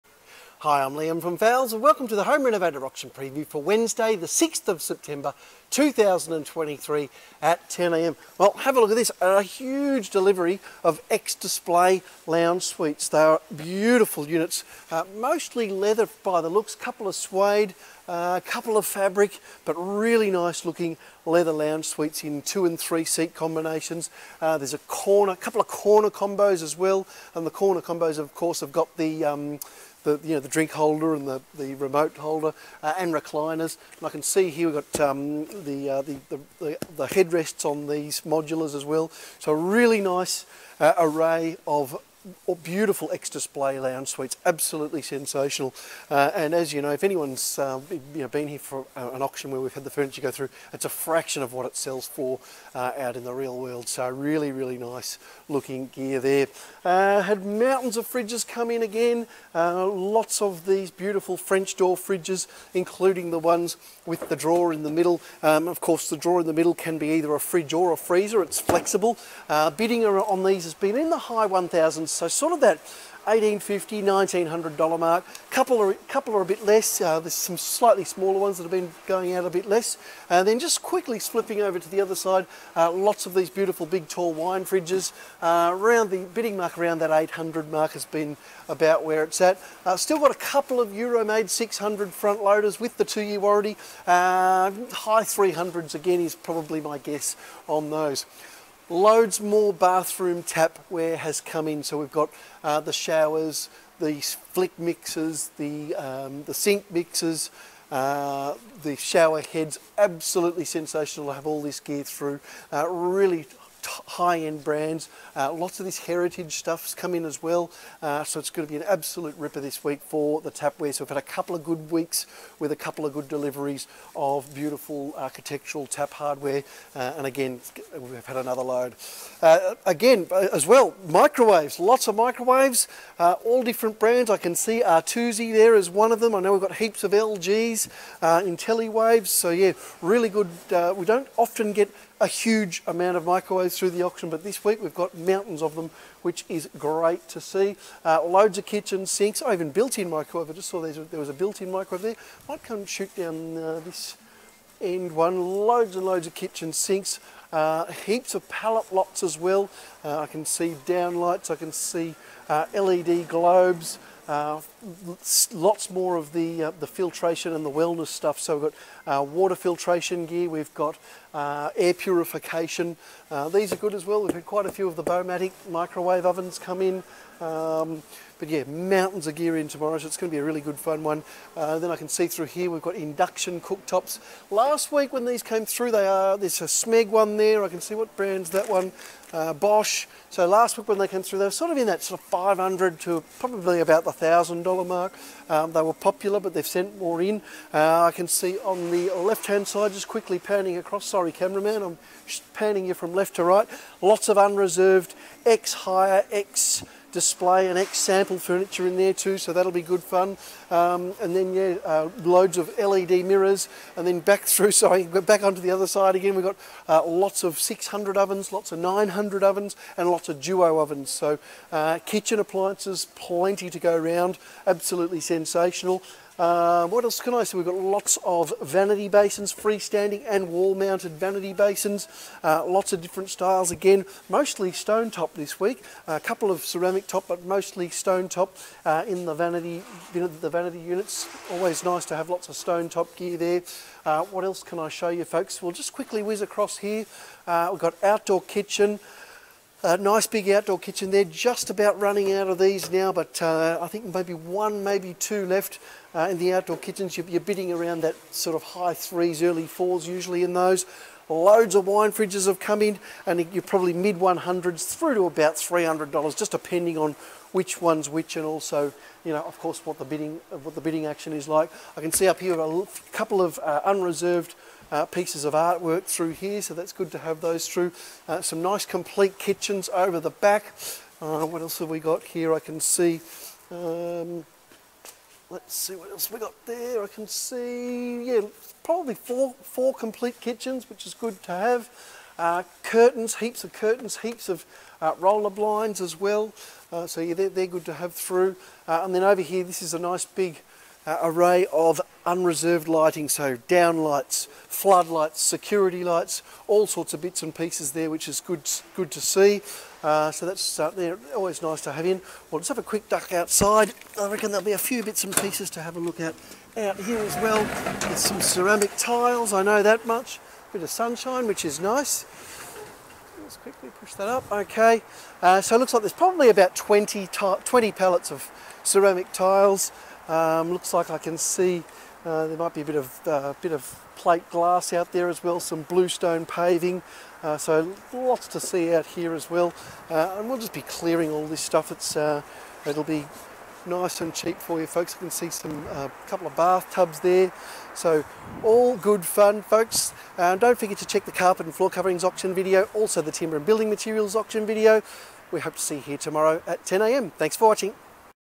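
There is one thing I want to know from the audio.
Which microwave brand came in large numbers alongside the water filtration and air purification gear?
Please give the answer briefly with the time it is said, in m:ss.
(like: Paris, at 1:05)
Baumatic, at 2:55.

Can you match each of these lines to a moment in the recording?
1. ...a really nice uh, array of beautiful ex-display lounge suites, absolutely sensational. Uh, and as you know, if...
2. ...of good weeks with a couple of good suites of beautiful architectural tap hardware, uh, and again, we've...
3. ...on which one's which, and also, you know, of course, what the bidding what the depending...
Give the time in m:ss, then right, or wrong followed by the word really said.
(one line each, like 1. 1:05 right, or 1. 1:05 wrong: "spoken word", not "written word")
1. 0:39 right
2. 2:01 wrong: "deliveries", not "suites"
3. 4:26 wrong: "bidding", not "depending".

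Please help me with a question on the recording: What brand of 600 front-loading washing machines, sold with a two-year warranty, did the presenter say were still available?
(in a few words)
Euromaid.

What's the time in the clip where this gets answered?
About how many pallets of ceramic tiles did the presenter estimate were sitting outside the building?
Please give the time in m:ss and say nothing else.
5:27.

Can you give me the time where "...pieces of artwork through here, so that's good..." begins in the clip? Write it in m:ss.
4:35.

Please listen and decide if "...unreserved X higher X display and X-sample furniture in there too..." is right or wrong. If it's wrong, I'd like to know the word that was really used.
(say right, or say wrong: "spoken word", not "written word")
right.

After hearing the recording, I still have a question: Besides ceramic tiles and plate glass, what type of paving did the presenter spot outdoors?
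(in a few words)
bluestone paving.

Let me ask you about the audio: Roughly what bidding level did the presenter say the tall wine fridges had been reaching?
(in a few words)
800.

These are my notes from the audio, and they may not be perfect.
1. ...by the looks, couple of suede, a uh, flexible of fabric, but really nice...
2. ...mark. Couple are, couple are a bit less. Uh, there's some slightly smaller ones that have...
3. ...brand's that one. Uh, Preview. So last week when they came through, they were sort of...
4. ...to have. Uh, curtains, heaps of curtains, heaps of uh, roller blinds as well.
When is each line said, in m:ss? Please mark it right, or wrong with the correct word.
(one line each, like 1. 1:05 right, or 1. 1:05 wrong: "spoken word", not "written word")
1. 0:16 wrong: "couple", not "flexible"
2. 1:14 right
3. 3:08 wrong: "Bosch", not "Preview"
4. 4:51 right.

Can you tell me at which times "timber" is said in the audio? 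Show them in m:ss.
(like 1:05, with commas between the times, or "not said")
5:53.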